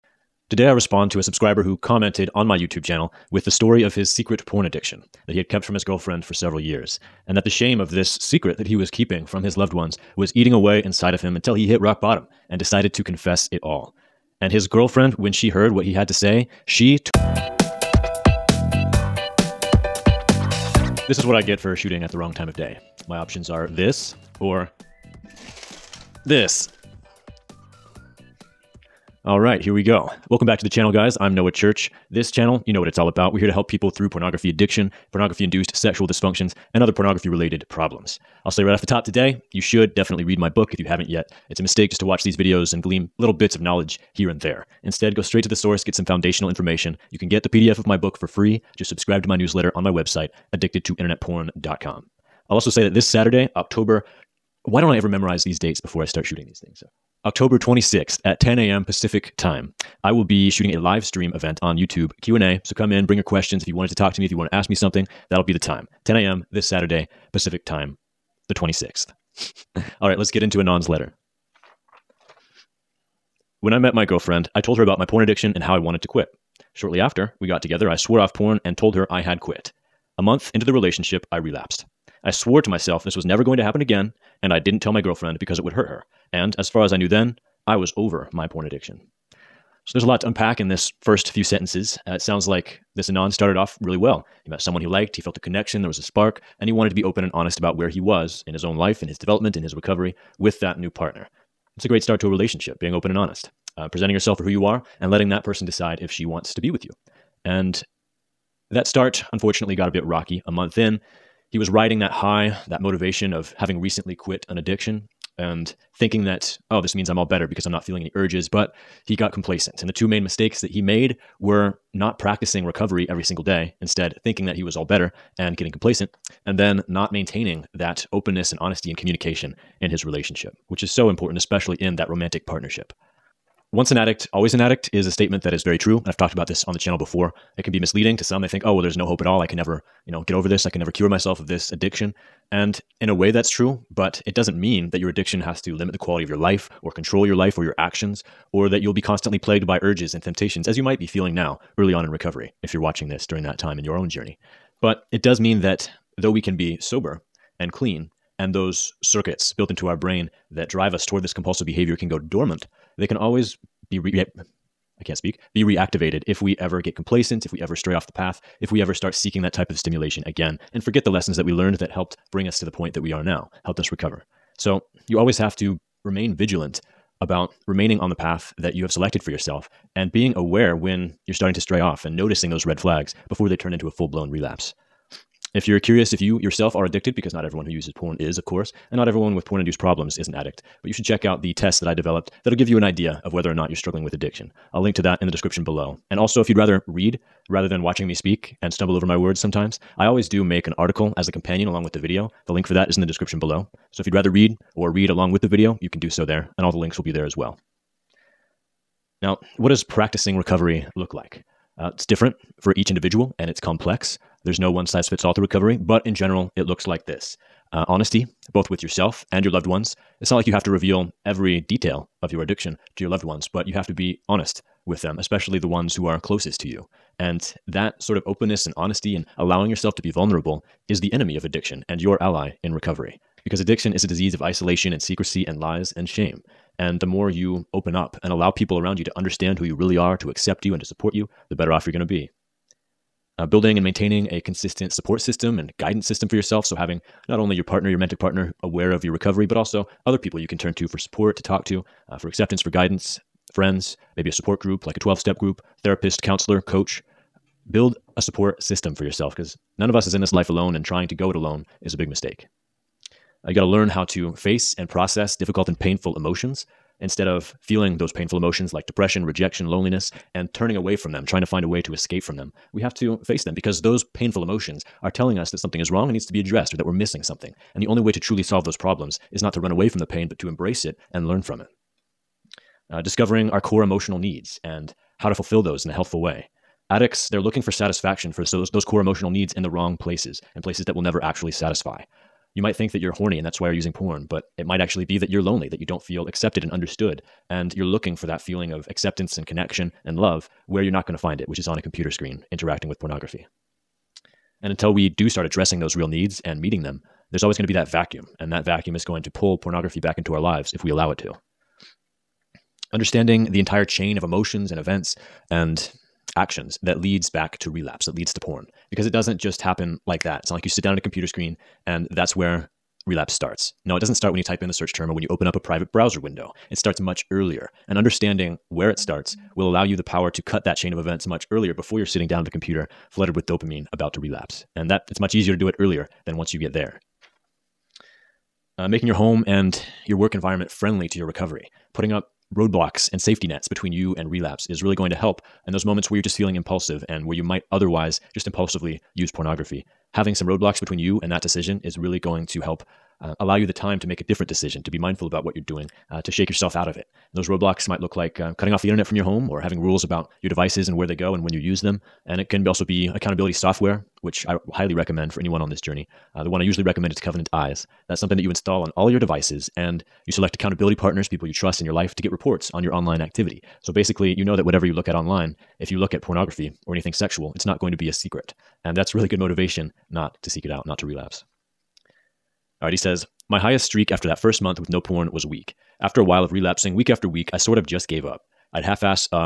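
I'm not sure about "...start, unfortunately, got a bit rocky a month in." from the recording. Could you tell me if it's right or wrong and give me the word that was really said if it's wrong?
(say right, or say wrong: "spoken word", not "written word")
right.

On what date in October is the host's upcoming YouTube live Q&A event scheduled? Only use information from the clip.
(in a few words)
October 26th.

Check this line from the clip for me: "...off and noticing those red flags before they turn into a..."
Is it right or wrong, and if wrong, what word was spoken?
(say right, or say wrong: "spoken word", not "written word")
right.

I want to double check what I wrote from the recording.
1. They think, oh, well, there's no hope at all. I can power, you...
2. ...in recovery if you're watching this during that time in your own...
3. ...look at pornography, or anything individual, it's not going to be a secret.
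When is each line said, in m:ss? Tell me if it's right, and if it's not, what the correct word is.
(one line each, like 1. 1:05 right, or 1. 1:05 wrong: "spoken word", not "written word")
1. 2:18 wrong: "never", not "power"
2. 2:32 right
3. 6:15 wrong: "sexual", not "individual".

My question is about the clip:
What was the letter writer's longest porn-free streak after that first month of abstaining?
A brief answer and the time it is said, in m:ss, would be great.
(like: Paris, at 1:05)
A week, at 6:25.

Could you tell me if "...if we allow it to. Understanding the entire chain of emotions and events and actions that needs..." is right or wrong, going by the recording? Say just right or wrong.
wrong.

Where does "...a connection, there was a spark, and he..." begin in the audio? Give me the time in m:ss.
1:35.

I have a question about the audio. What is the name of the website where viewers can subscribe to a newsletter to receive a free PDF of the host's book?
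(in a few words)
addictedtointernetporn.com.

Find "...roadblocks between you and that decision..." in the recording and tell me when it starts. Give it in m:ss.
5:50.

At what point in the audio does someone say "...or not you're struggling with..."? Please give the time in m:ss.
3:13.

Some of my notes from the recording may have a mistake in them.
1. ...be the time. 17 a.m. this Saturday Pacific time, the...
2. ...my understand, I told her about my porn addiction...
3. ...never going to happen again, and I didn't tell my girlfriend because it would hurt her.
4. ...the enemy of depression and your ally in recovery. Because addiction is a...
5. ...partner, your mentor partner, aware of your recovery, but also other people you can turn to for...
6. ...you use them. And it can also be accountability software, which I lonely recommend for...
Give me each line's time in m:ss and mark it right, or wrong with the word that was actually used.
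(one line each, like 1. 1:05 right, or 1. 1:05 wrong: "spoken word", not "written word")
1. 1:05 wrong: "10", not "17"
2. 1:13 wrong: "girlfriend", not "understand"
3. 1:23 right
4. 3:50 wrong: "addiction", not "depression"
5. 4:07 right
6. 6:01 wrong: "highly", not "lonely".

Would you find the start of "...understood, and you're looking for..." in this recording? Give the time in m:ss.
4:56.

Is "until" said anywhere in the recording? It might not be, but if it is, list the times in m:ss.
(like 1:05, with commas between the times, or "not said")
0:11, 5:04.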